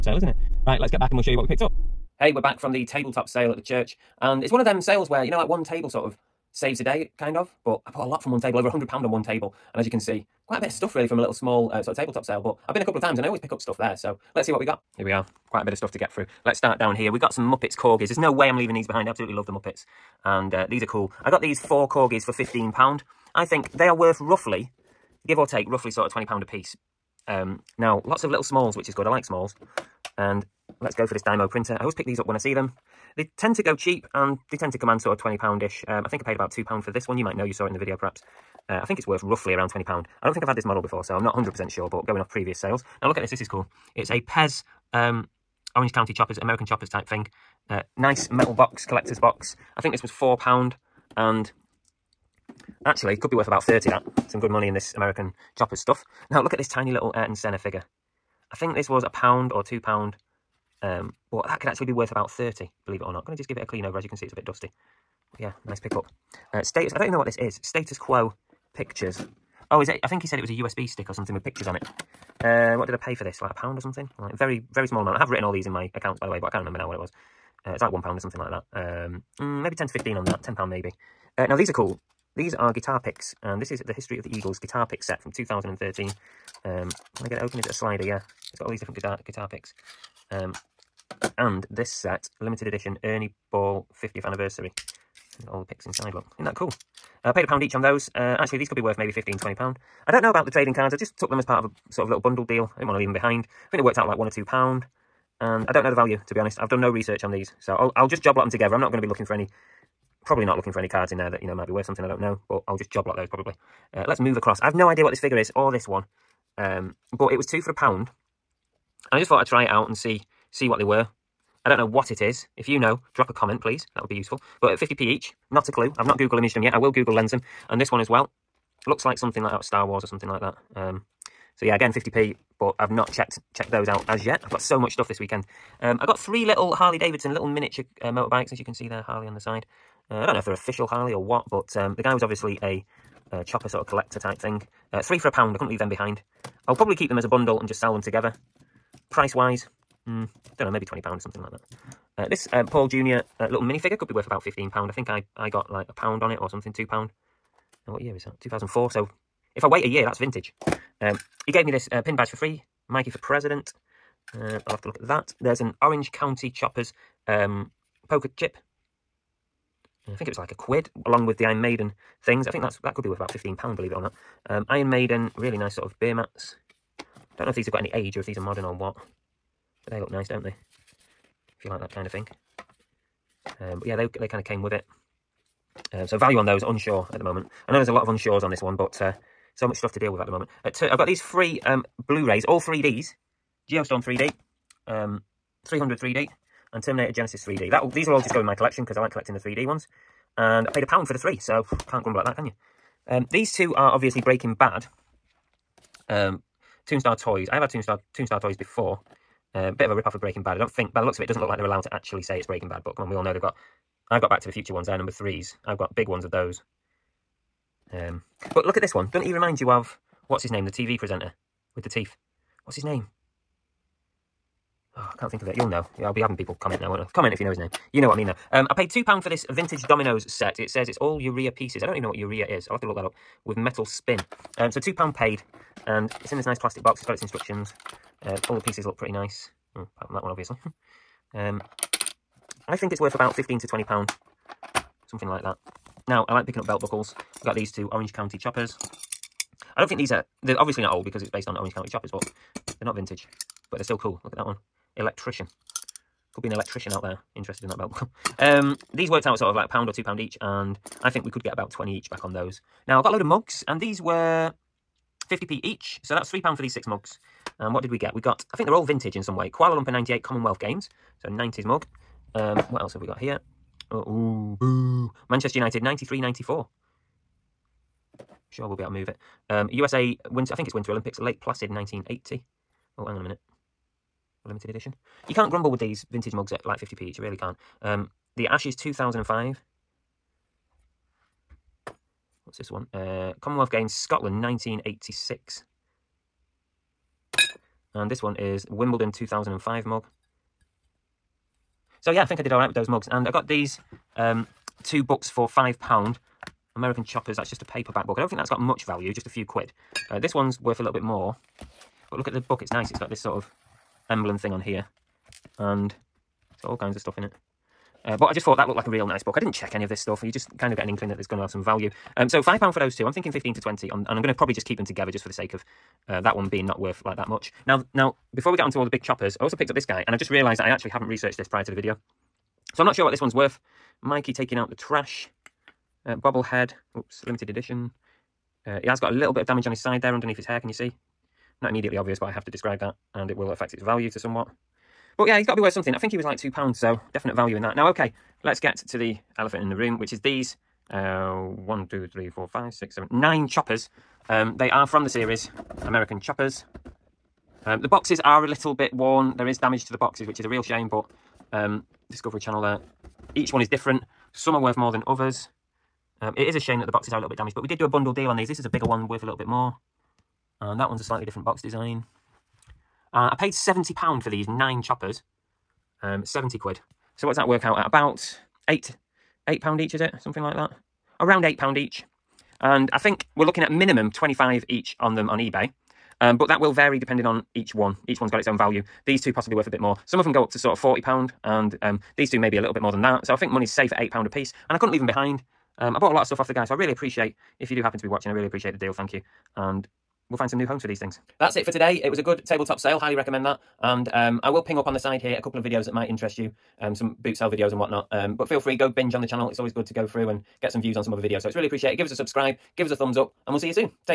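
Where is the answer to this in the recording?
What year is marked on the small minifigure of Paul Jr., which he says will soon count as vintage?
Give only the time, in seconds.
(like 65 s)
158 s.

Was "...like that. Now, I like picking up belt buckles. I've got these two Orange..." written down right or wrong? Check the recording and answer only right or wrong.
right.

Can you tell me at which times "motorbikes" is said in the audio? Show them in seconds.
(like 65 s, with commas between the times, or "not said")
138 s.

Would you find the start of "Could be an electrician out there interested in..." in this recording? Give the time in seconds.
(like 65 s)
256 s.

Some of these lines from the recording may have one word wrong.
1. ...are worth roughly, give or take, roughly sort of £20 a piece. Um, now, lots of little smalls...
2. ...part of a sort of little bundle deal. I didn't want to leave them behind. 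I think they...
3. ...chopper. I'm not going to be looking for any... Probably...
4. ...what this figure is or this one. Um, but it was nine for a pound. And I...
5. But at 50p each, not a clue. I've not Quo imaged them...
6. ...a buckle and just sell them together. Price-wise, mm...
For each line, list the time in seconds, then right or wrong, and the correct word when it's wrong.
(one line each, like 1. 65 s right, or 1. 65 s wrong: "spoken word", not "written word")
1. 23 s right
2. 101 s right
3. 108 s wrong: "together", not "chopper"
4. 115 s wrong: "two", not "nine"
5. 124 s wrong: "Google", not "Quo"
6. 147 s wrong: "bundle", not "buckle".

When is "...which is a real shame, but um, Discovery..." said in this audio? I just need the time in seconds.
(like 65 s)
360 s.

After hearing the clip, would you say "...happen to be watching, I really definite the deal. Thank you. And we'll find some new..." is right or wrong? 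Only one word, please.
wrong.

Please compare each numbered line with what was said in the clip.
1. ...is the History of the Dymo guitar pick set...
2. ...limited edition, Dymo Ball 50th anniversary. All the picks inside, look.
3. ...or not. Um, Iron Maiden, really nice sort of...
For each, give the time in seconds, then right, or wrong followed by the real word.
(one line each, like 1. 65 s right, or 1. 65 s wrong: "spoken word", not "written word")
1. 83 s wrong: "Eagles", not "Dymo"
2. 92 s wrong: "Ernie", not "Dymo"
3. 173 s right.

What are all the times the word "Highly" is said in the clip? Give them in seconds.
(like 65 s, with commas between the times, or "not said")
402 s.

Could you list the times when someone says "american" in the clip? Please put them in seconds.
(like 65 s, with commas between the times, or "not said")
46 s, 54 s, 306 s, 355 s.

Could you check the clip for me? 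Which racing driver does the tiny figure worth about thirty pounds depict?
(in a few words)
Ayrton Senna.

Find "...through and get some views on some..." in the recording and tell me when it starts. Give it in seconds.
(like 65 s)
410 s.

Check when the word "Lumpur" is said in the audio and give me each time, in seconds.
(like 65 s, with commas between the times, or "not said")
269 s.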